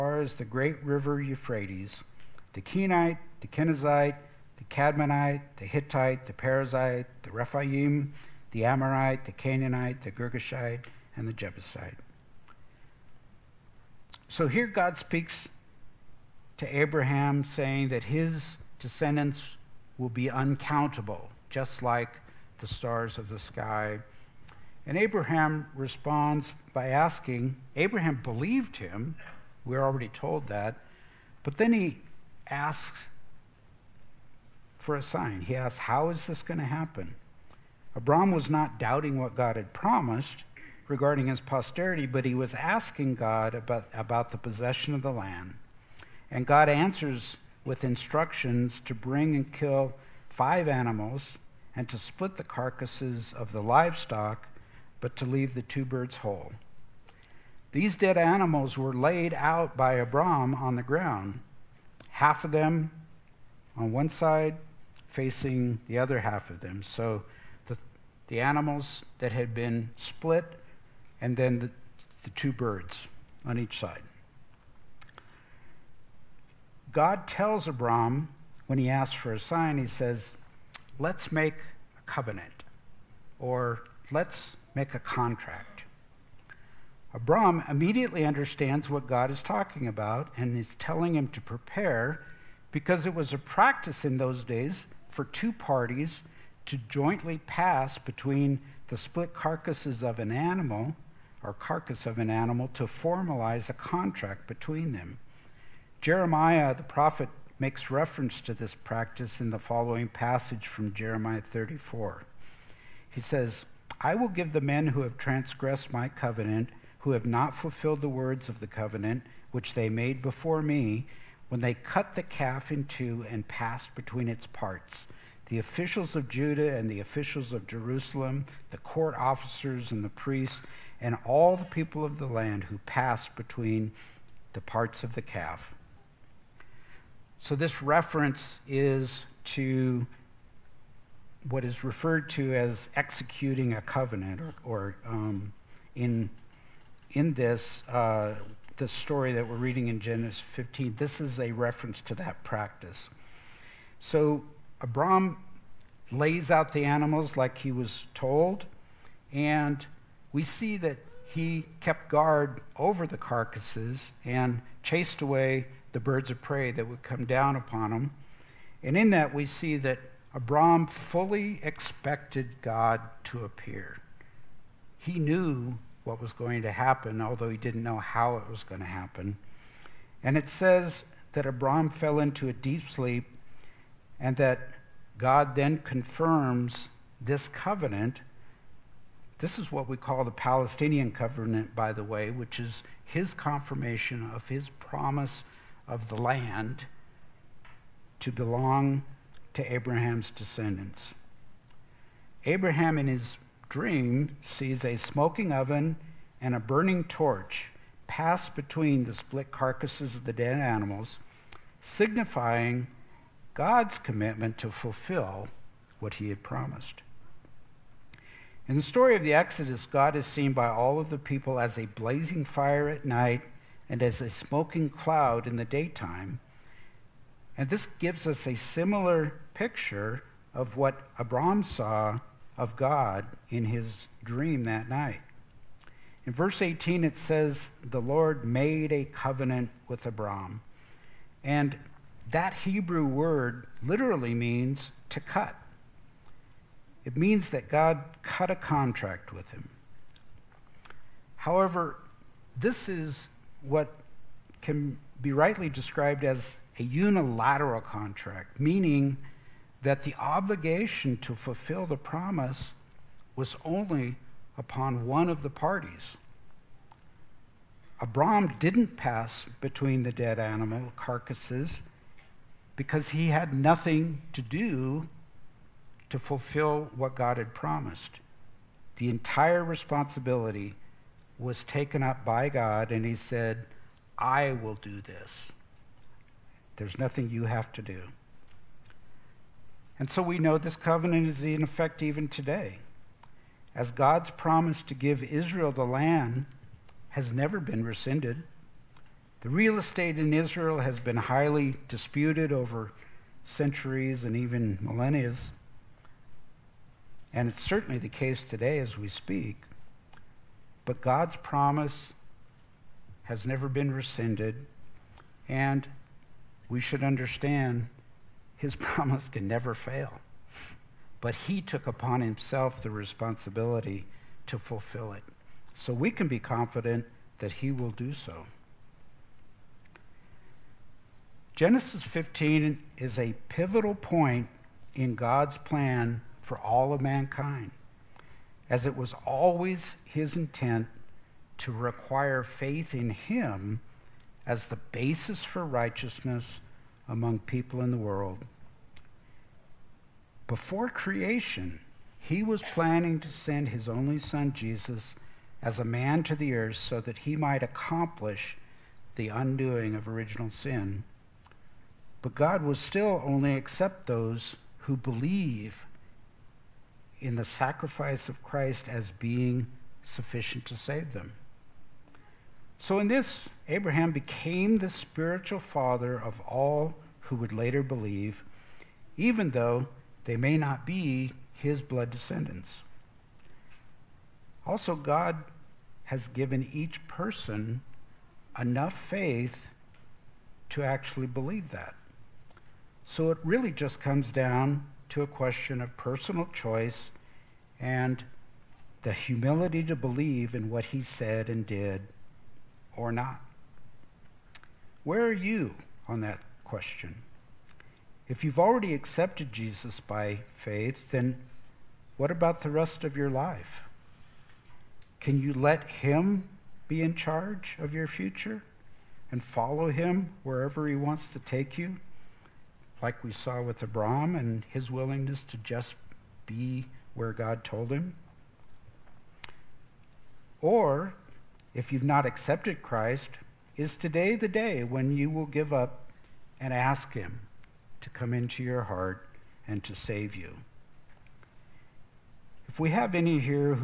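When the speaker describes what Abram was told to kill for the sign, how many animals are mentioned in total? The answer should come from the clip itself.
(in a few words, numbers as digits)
5.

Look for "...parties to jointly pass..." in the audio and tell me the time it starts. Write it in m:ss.
1:35.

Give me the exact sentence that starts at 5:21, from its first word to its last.
But he took upon himself the responsibility to fulfill it.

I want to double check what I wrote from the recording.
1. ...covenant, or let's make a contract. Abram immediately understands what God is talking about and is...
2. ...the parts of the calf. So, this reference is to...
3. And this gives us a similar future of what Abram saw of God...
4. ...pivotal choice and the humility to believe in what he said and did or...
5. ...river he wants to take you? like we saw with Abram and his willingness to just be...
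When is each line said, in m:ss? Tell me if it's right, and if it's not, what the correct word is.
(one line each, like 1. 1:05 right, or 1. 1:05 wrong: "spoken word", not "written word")
1. 1:22 right
2. 2:14 right
3. 3:47 wrong: "picture", not "future"
4. 6:35 wrong: "personal", not "pivotal"
5. 7:00 wrong: "wherever", not "river".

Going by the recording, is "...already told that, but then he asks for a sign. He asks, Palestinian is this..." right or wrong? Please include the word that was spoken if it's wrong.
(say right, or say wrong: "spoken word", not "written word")
wrong: "How", not "Palestinian".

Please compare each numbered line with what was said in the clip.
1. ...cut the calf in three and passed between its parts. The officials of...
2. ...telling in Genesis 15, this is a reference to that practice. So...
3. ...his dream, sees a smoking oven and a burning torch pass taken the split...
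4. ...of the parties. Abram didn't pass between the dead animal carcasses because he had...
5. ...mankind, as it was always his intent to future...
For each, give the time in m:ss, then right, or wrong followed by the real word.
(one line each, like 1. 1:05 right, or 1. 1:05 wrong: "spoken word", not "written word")
1. 2:01 wrong: "two", not "three"
2. 2:29 wrong: "reading", not "telling"
3. 3:23 wrong: "between", not "taken"
4. 4:25 right
5. 5:37 wrong: "require", not "future".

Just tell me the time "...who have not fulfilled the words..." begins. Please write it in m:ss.
1:57.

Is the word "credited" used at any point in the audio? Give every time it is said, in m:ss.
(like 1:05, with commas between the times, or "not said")
not said.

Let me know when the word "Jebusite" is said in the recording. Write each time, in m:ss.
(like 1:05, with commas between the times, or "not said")
0:11.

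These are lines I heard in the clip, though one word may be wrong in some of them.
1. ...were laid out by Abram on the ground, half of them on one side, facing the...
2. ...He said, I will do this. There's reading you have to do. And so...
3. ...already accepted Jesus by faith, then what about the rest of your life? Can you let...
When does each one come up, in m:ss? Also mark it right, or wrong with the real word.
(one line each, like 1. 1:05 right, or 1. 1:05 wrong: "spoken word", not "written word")
1. 0:58 right
2. 4:43 wrong: "nothing", not "reading"
3. 6:48 right.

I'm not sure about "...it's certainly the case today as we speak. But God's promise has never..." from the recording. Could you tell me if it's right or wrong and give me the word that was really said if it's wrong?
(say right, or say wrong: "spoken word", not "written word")
right.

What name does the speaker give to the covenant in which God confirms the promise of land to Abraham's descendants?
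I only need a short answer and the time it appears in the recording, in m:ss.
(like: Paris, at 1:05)
Palestinian covenant, at 3:10.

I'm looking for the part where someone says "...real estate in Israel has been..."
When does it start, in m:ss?
4:59.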